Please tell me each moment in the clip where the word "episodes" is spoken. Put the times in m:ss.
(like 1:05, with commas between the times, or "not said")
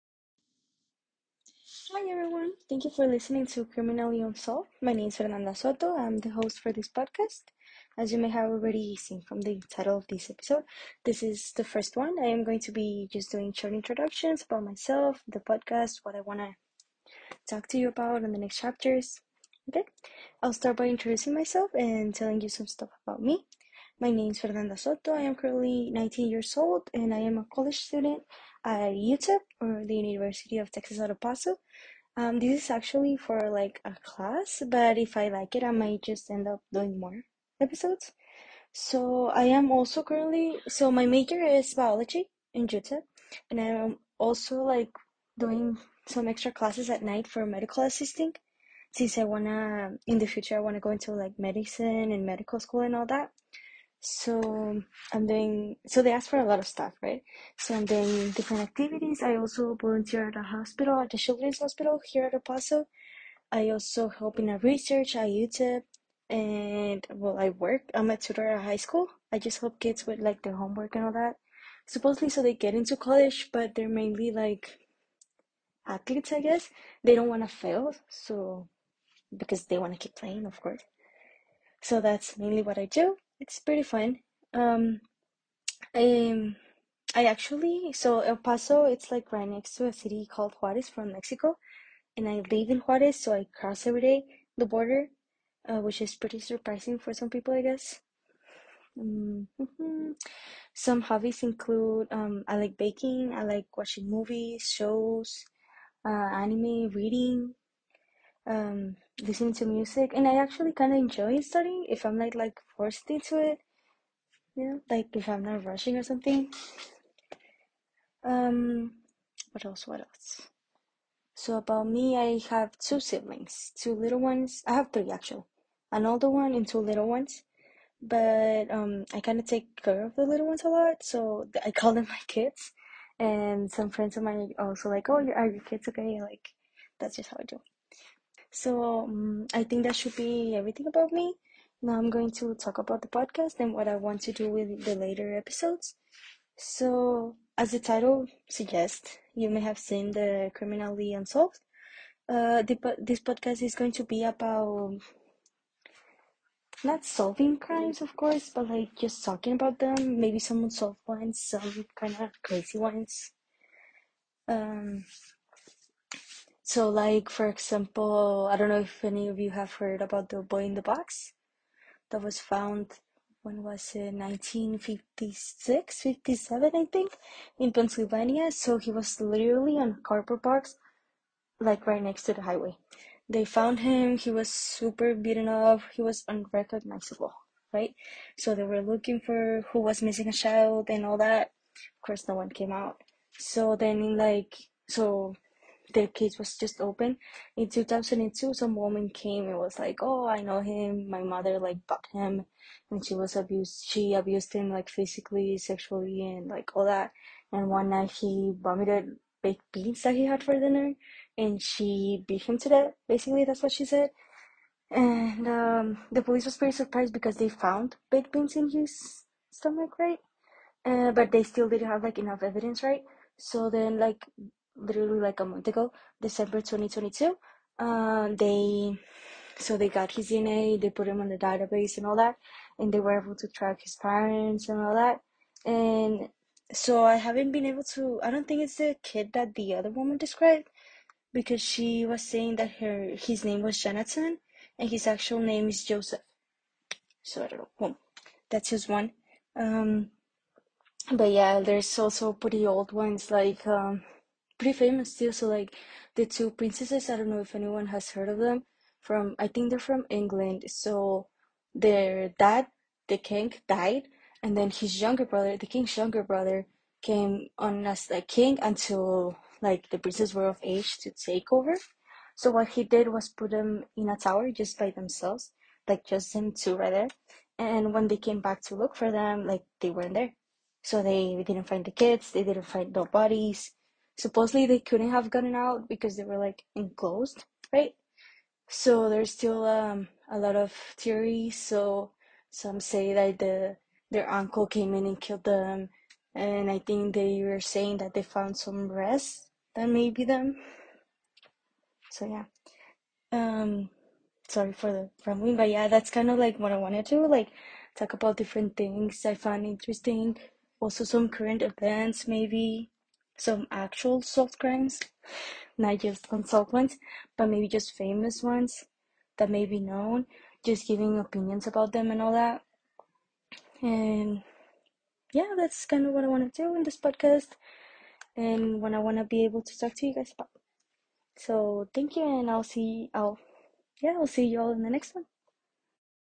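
0:10, 0:37, 2:25.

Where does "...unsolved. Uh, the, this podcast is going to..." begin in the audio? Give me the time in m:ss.
2:31.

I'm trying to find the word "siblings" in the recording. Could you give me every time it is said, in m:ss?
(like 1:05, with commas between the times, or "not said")
2:02.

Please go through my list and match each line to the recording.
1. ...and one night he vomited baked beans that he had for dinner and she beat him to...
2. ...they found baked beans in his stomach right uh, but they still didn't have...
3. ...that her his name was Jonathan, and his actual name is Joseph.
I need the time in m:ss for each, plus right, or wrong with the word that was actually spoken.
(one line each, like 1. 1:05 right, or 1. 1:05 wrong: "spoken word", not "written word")
1. 3:27 right
2. 3:37 right
3. 4:02 right.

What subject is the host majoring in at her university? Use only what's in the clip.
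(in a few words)
Biology.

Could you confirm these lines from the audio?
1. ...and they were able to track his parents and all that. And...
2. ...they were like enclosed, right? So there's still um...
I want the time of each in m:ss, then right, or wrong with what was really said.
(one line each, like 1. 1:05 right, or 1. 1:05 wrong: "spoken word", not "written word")
1. 3:52 right
2. 4:46 right.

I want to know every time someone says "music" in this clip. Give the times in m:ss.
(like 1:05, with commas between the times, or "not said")
1:49.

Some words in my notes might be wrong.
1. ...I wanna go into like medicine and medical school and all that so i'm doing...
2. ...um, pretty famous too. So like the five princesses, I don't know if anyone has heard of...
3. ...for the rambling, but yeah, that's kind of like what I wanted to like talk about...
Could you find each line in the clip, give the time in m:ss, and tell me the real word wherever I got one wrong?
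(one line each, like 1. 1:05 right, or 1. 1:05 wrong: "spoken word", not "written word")
1. 0:50 right
2. 4:13 wrong: "two", not "five"
3. 5:04 right.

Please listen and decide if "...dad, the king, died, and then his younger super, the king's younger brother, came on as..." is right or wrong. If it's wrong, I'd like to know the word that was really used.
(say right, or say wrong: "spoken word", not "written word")
wrong: "brother", not "super".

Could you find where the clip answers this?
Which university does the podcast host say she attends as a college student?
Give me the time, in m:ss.
0:29.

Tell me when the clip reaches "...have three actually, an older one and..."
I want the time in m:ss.
2:04.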